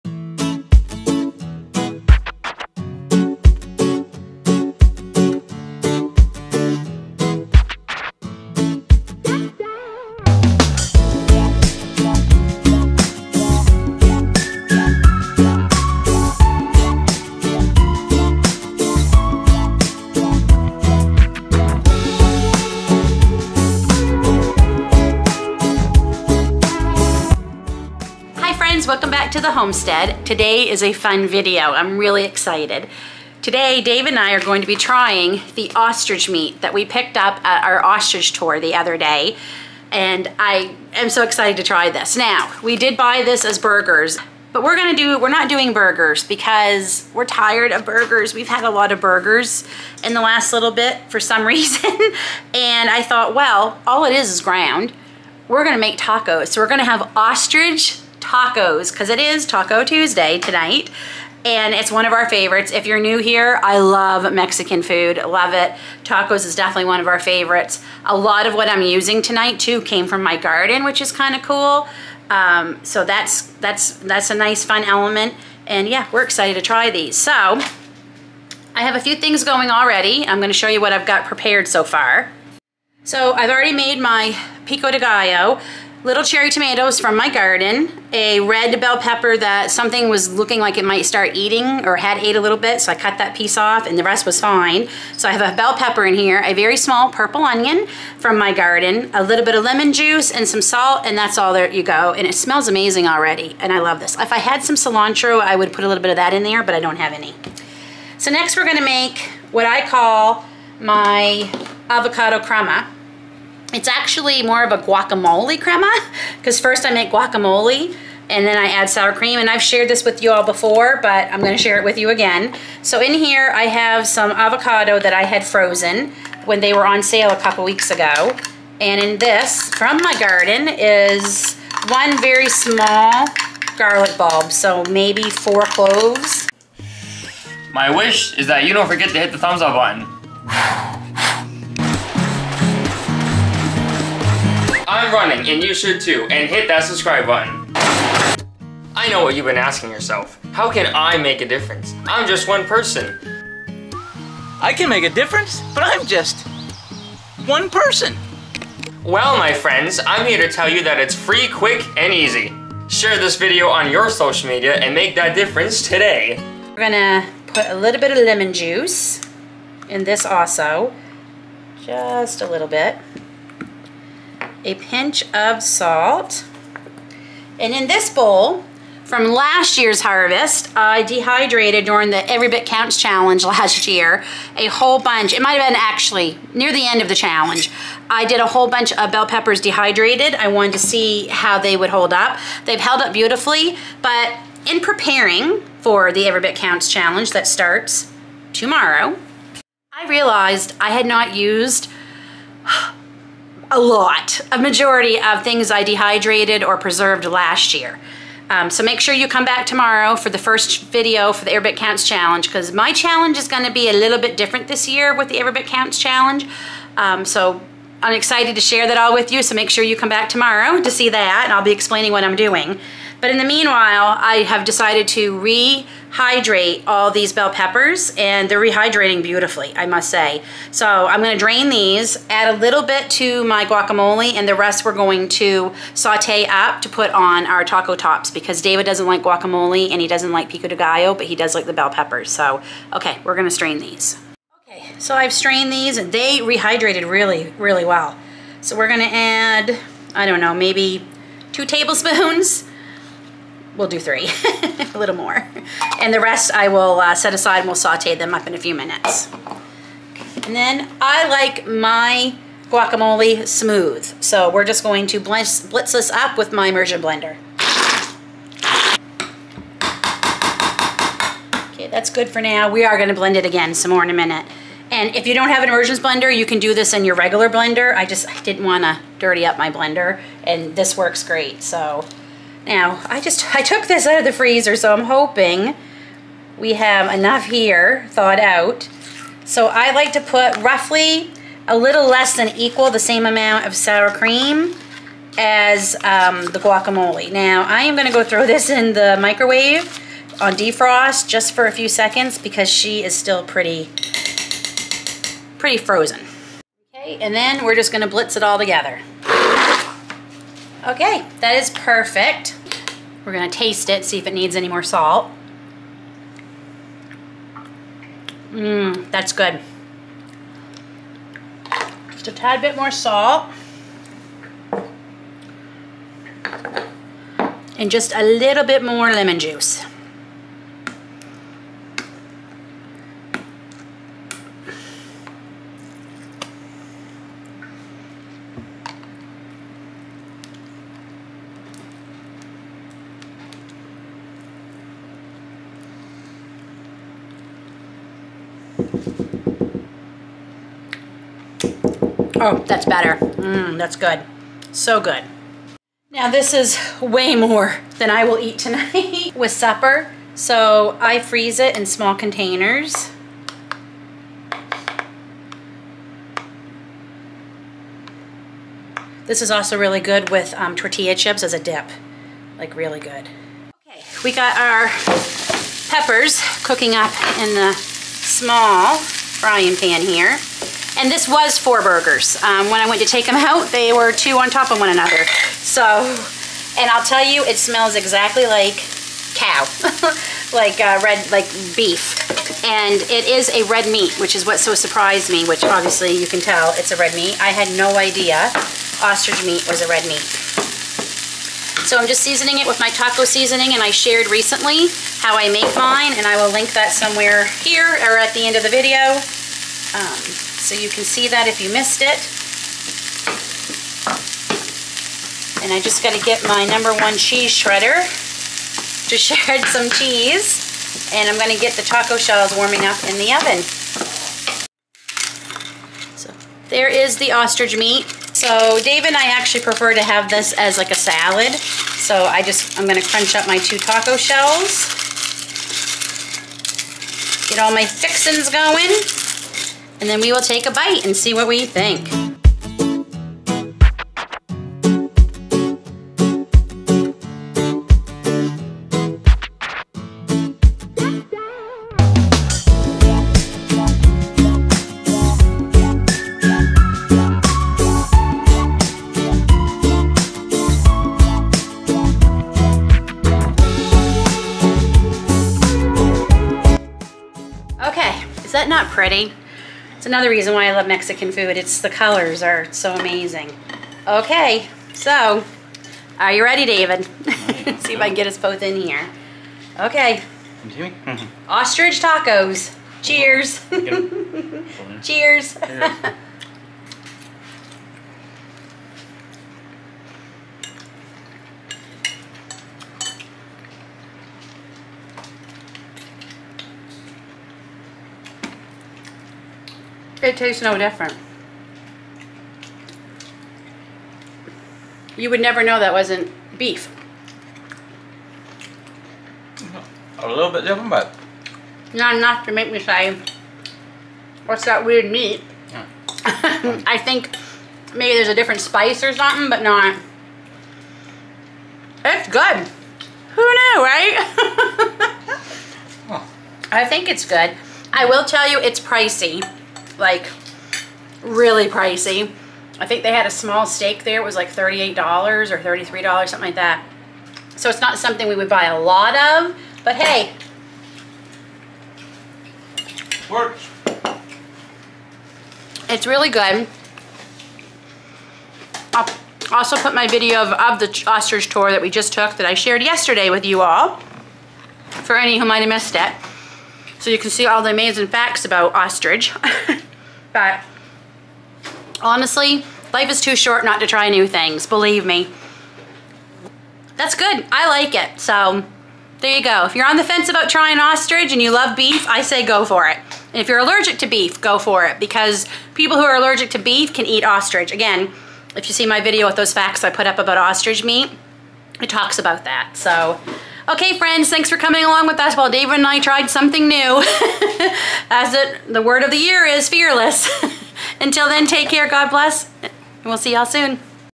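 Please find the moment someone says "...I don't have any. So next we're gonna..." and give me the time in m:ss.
1:46.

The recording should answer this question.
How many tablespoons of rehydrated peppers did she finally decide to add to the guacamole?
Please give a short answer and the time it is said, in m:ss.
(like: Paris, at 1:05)
3, at 4:13.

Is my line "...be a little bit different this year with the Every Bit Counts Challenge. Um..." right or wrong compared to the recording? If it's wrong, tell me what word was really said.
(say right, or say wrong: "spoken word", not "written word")
right.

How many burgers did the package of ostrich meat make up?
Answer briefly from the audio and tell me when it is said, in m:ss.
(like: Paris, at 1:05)
4, at 6:21.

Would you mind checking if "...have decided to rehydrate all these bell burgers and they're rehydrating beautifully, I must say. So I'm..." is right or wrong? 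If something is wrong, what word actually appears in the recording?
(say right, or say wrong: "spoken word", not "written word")
wrong: "peppers", not "burgers".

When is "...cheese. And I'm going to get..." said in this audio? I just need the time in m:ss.
6:59.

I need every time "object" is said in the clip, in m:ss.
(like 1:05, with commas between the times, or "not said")
not said.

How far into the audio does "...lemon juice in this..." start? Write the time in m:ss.
2:48.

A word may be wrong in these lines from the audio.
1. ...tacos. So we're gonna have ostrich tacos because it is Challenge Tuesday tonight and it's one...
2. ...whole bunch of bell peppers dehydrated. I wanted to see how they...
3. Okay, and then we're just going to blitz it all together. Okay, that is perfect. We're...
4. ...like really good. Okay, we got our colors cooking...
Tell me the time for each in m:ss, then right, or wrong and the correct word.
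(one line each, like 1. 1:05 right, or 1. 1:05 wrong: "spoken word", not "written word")
1. 0:55 wrong: "Taco", not "Challenge"
2. 3:08 right
3. 5:06 right
4. 6:12 wrong: "peppers", not "colors".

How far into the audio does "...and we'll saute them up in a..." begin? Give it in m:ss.
4:17.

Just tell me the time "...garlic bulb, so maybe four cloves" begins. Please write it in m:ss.
2:13.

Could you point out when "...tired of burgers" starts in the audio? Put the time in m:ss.
0:47.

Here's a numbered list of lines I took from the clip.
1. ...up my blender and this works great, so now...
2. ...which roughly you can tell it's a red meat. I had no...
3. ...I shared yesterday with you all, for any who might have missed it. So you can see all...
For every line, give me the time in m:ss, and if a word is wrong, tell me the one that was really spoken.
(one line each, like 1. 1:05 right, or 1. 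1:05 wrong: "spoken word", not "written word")
1. 4:39 right
2. 6:35 wrong: "obviously", not "roughly"
3. 9:12 right.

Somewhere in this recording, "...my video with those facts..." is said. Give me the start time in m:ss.
9:38.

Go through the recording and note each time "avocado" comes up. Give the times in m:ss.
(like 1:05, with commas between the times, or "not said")
1:51, 2:04.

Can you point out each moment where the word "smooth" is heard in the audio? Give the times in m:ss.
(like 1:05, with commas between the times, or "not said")
4:23.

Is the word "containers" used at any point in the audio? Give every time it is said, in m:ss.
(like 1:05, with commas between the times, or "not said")
6:02.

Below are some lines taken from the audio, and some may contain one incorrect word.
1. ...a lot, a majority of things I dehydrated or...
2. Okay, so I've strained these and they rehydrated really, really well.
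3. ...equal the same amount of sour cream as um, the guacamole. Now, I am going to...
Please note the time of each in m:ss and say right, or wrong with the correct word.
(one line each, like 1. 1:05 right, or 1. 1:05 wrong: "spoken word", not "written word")
1. 3:23 right
2. 4:04 right
3. 4:52 right.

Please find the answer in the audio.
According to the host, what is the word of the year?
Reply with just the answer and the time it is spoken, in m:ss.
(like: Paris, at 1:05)
Fearless, at 9:49.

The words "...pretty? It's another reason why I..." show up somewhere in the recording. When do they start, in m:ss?
7:48.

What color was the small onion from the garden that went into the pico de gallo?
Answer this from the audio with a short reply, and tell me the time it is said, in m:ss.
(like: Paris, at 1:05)
Purple, at 1:37.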